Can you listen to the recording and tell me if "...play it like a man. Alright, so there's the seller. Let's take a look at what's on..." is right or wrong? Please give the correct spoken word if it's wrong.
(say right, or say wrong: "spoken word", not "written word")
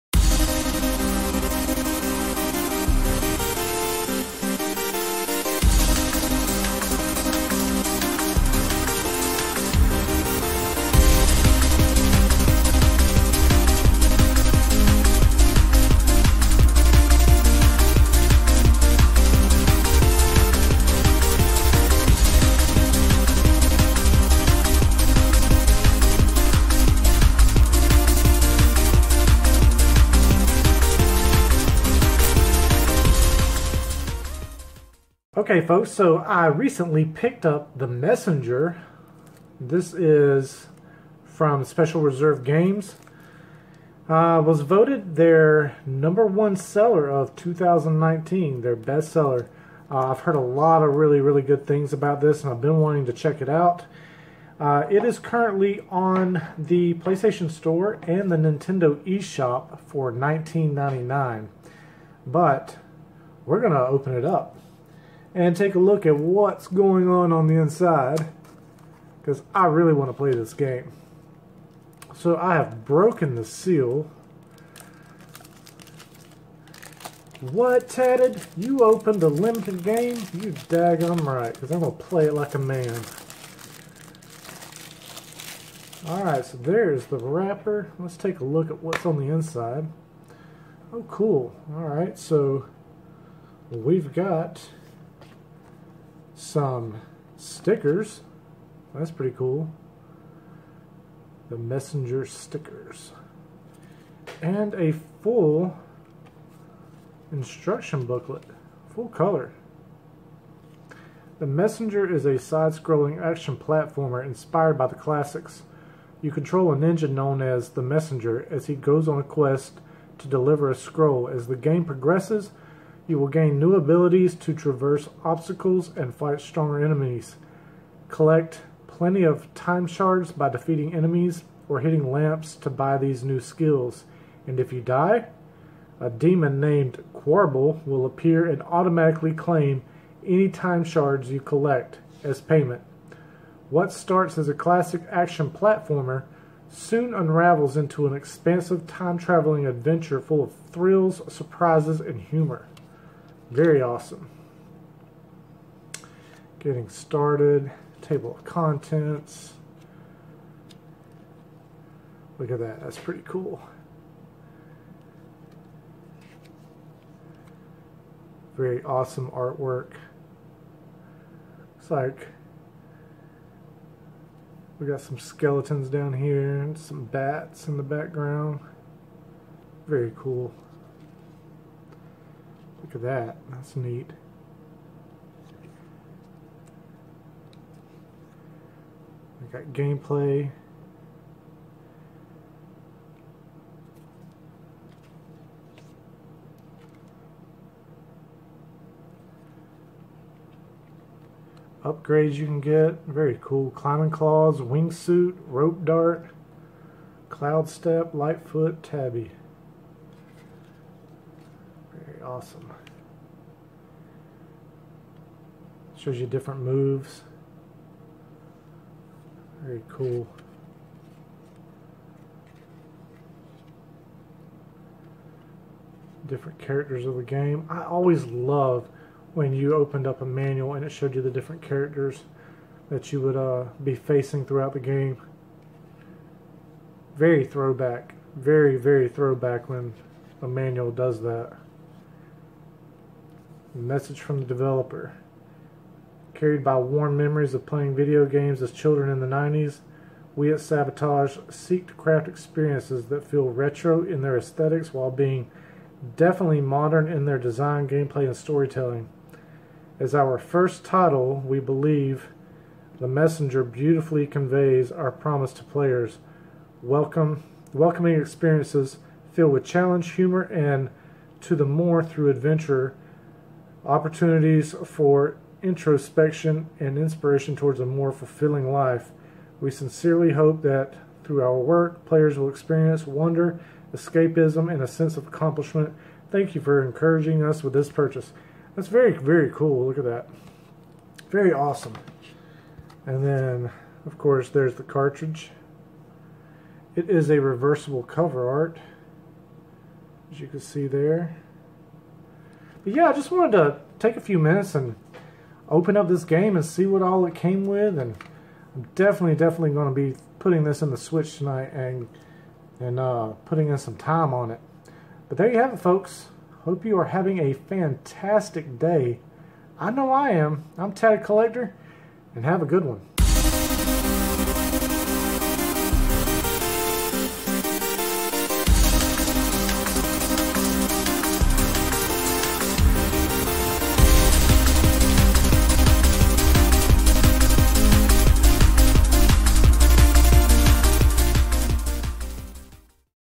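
wrong: "wrapper", not "seller".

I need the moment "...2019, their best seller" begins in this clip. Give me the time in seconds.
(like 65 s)
47 s.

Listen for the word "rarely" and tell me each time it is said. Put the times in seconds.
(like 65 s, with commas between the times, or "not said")
not said.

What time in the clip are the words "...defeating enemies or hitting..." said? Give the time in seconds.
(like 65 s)
130 s.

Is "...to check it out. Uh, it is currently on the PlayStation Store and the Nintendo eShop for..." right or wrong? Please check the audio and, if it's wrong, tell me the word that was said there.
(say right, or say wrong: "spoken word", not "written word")
right.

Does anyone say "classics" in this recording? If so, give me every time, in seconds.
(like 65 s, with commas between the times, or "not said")
114 s, 144 s.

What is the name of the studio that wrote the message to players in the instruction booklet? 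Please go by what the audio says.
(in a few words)
Sabotage.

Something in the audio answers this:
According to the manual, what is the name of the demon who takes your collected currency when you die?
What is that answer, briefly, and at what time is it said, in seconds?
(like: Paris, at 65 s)
Quarble, at 137 s.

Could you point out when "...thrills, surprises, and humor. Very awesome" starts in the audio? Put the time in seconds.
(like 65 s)
150 s.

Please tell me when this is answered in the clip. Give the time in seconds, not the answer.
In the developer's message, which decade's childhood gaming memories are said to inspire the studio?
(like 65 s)
249 s.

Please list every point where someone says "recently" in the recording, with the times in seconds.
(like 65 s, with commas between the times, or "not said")
36 s.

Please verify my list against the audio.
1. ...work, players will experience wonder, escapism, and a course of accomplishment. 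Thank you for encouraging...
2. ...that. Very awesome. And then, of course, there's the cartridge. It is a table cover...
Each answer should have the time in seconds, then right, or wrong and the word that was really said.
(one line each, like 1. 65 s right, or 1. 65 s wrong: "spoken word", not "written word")
1. 281 s wrong: "sense", not "course"
2. 290 s wrong: "reversible", not "table".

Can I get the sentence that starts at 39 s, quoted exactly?
This is from Special Reserve Games.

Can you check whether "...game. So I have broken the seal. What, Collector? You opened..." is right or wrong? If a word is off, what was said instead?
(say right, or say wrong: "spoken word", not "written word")
wrong: "Tatted", not "Collector".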